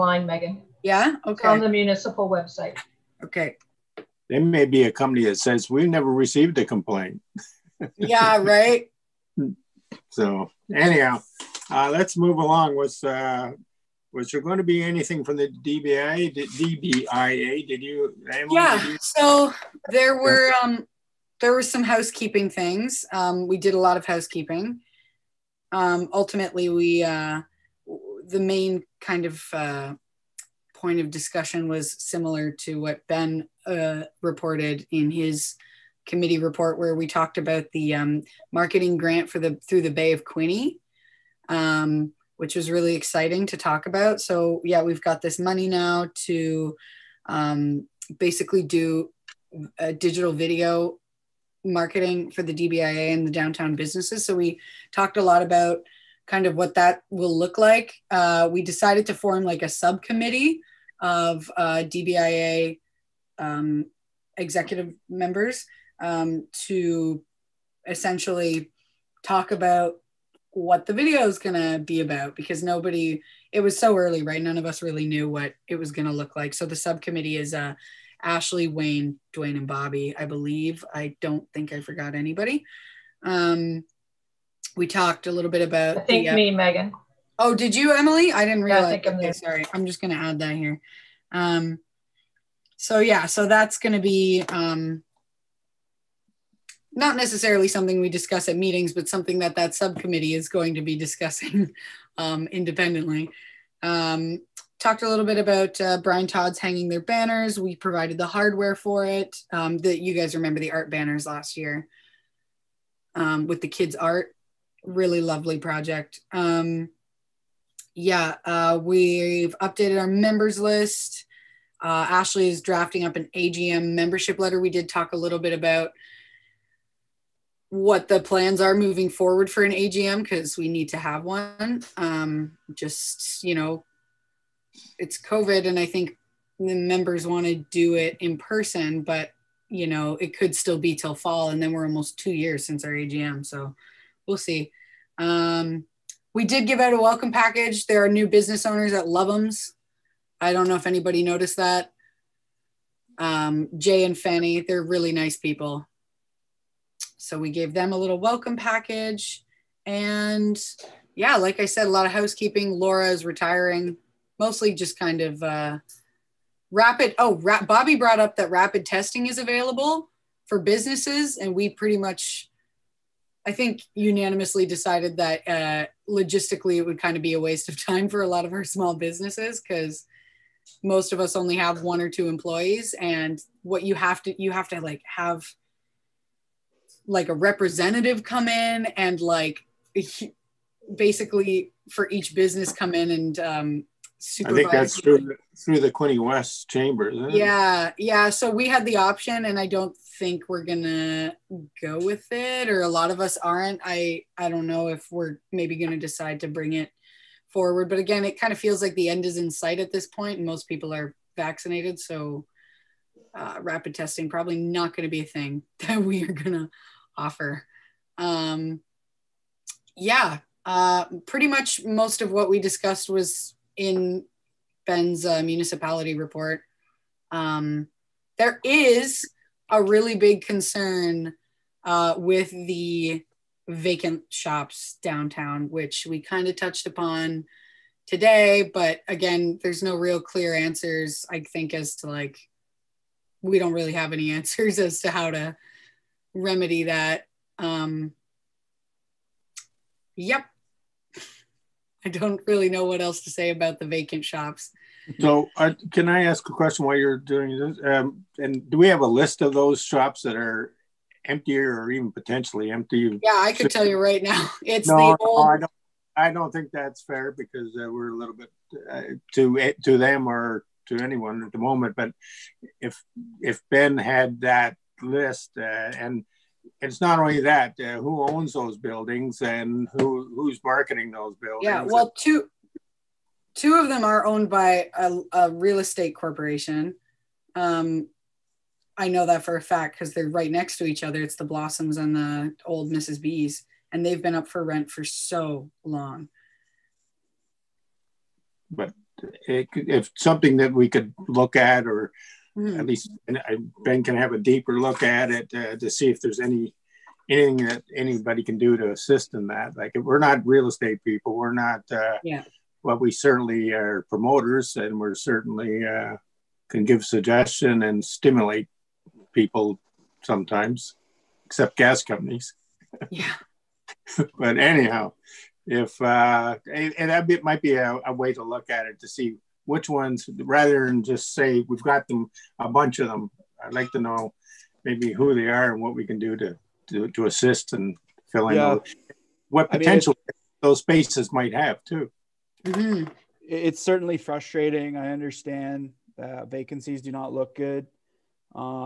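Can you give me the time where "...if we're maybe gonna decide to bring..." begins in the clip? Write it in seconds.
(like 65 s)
204 s.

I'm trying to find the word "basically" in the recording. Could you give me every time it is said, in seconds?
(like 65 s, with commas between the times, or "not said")
48 s, 190 s.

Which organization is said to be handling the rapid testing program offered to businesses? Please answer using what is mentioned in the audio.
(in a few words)
Quinte West chamber.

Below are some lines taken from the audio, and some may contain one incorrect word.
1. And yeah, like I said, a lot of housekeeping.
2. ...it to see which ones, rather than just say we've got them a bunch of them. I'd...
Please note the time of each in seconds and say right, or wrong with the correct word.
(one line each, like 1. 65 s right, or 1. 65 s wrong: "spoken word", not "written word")
1. 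159 s right
2. 328 s right.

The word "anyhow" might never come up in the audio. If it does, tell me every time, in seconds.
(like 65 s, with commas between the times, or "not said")
10 s, 324 s.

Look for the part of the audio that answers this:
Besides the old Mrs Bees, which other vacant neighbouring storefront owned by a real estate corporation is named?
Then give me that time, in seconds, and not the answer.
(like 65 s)
291 s.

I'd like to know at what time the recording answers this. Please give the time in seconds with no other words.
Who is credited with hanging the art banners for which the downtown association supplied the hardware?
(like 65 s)
105 s.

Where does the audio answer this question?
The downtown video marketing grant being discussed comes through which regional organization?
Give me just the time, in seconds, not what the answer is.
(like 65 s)
39 s.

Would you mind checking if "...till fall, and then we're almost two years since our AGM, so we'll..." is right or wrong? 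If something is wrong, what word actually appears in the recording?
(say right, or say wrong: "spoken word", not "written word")
right.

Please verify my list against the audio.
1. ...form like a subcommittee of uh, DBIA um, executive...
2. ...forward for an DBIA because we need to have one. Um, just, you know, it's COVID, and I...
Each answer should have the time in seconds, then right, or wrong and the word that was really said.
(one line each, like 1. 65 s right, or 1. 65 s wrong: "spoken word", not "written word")
1. 59 s right
2. 129 s wrong: "AGM", not "DBIA".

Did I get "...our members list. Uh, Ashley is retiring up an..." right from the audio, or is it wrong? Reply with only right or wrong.
wrong.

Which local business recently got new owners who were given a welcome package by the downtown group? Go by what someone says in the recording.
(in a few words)
Loveums.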